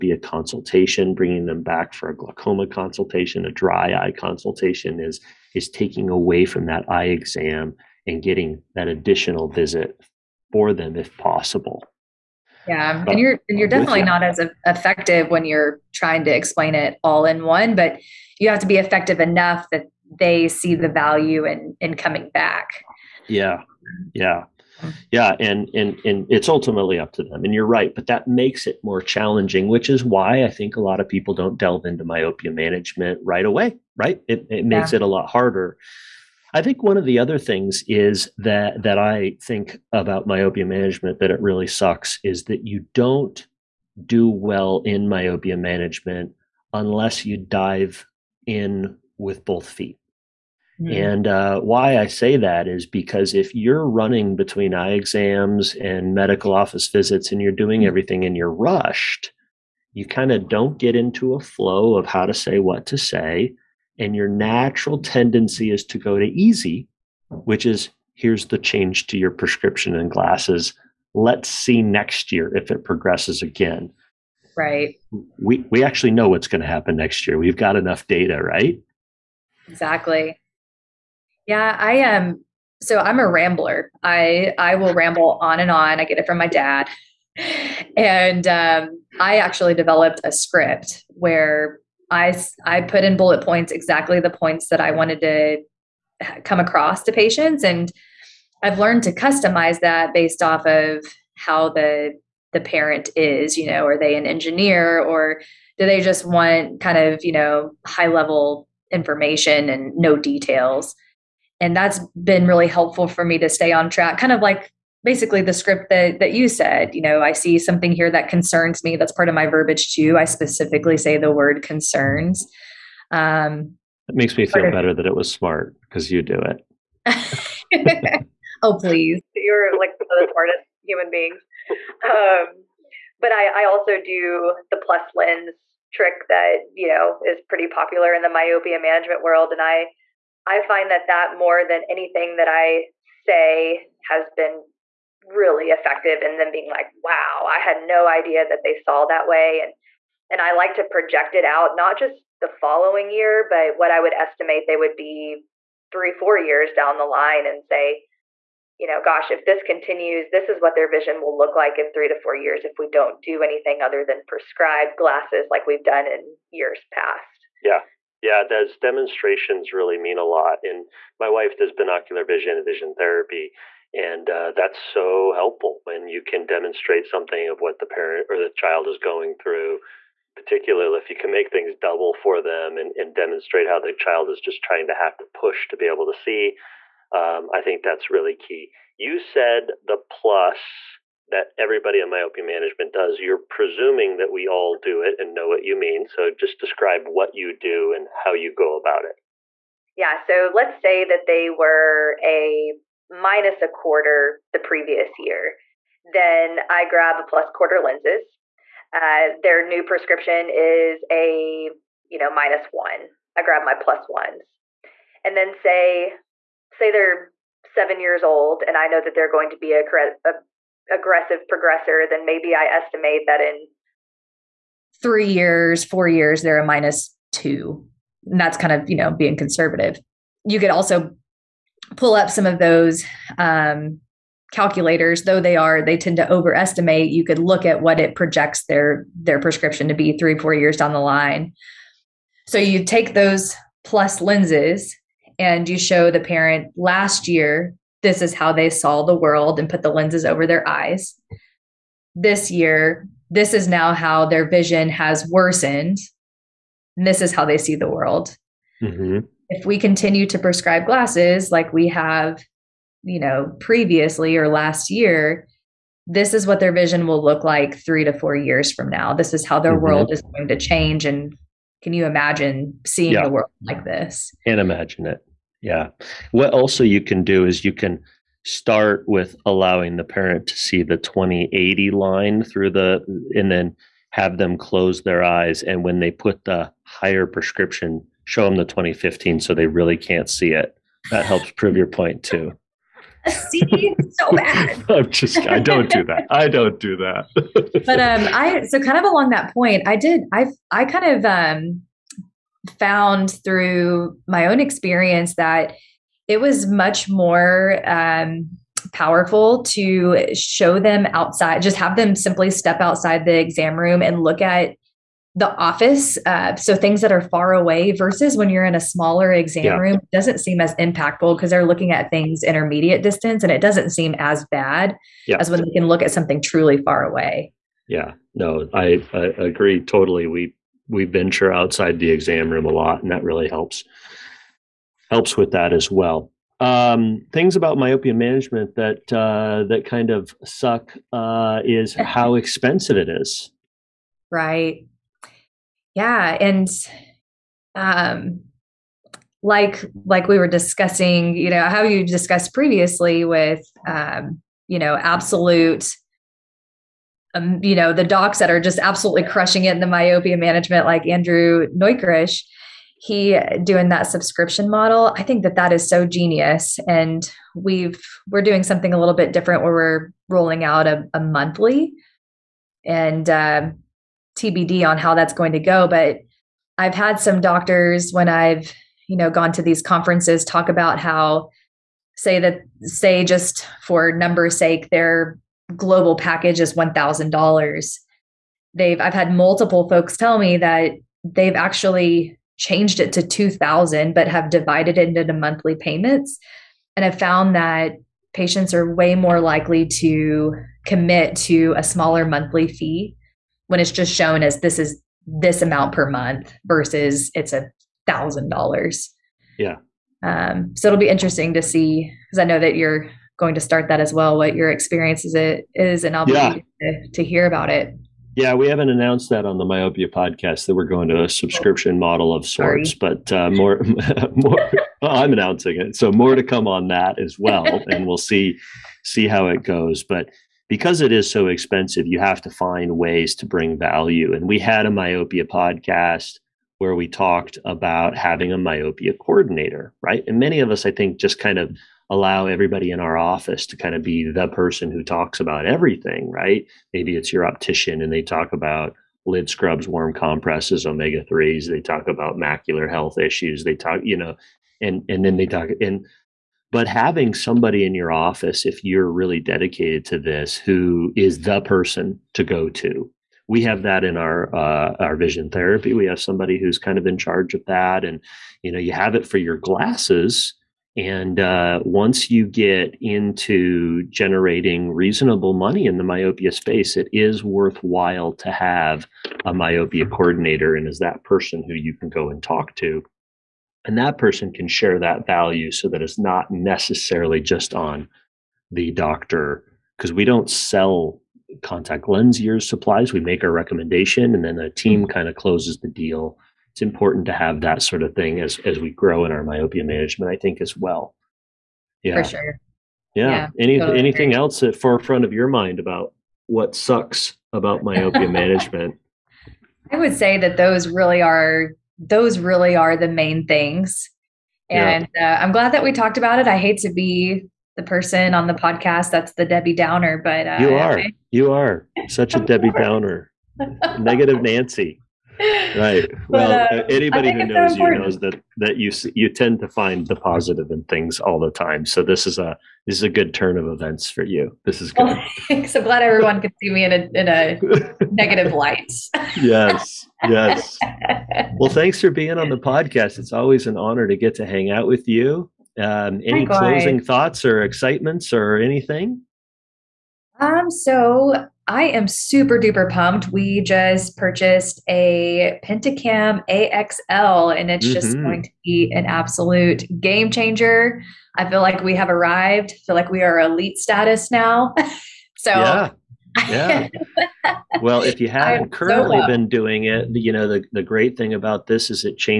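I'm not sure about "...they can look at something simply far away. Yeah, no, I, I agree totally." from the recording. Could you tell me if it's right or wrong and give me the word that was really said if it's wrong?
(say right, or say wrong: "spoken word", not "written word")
wrong: "truly", not "simply".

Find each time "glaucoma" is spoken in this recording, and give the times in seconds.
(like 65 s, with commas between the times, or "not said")
2 s.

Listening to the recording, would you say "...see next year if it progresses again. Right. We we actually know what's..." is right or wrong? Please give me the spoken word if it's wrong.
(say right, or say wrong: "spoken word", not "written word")
right.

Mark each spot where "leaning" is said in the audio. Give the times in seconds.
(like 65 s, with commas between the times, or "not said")
not said.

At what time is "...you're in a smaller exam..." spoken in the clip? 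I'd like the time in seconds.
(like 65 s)
318 s.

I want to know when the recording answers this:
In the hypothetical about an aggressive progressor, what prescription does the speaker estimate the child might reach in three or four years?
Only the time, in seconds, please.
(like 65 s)
226 s.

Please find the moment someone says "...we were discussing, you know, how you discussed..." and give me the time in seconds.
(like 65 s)
350 s.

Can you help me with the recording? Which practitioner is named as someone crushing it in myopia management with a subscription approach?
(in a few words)
Andrew Neukrish.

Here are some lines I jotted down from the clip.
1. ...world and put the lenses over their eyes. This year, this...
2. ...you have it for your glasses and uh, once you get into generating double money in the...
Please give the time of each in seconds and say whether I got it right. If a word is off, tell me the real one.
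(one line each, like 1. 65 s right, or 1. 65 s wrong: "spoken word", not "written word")
1. 249 s right
2. 468 s wrong: "reasonable", not "double".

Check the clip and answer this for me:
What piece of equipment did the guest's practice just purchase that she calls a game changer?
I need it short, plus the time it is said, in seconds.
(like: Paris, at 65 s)
Pentacam AXL, at 555 s.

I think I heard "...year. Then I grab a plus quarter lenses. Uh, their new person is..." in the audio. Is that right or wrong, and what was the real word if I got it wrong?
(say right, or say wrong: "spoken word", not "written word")
wrong: "prescription", not "person".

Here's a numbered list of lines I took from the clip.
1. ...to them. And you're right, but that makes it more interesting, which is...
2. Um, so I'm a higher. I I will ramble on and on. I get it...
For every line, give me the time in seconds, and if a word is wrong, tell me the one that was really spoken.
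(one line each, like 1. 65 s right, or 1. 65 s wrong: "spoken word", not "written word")
1. 27 s wrong: "challenging", not "interesting"
2. 82 s wrong: "rambler", not "higher".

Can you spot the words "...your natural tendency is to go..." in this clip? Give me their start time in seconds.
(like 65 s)
64 s.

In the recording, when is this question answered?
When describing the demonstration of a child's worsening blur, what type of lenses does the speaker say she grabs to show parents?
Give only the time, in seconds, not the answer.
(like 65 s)
243 s.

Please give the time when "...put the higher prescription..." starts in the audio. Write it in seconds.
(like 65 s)
286 s.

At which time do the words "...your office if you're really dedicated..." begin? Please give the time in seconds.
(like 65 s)
457 s.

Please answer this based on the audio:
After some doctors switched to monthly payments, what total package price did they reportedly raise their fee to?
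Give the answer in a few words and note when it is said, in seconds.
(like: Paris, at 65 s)
2000, at 393 s.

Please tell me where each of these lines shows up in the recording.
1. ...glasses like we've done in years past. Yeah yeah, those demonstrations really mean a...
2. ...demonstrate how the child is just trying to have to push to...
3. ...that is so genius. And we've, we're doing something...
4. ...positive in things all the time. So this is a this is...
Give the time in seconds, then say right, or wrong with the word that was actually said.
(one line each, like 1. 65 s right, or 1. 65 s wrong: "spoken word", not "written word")
1. 164 s right
2. 183 s right
3. 365 s right
4. 530 s right.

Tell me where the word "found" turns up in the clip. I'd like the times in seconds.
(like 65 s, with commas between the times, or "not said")
302 s, 397 s.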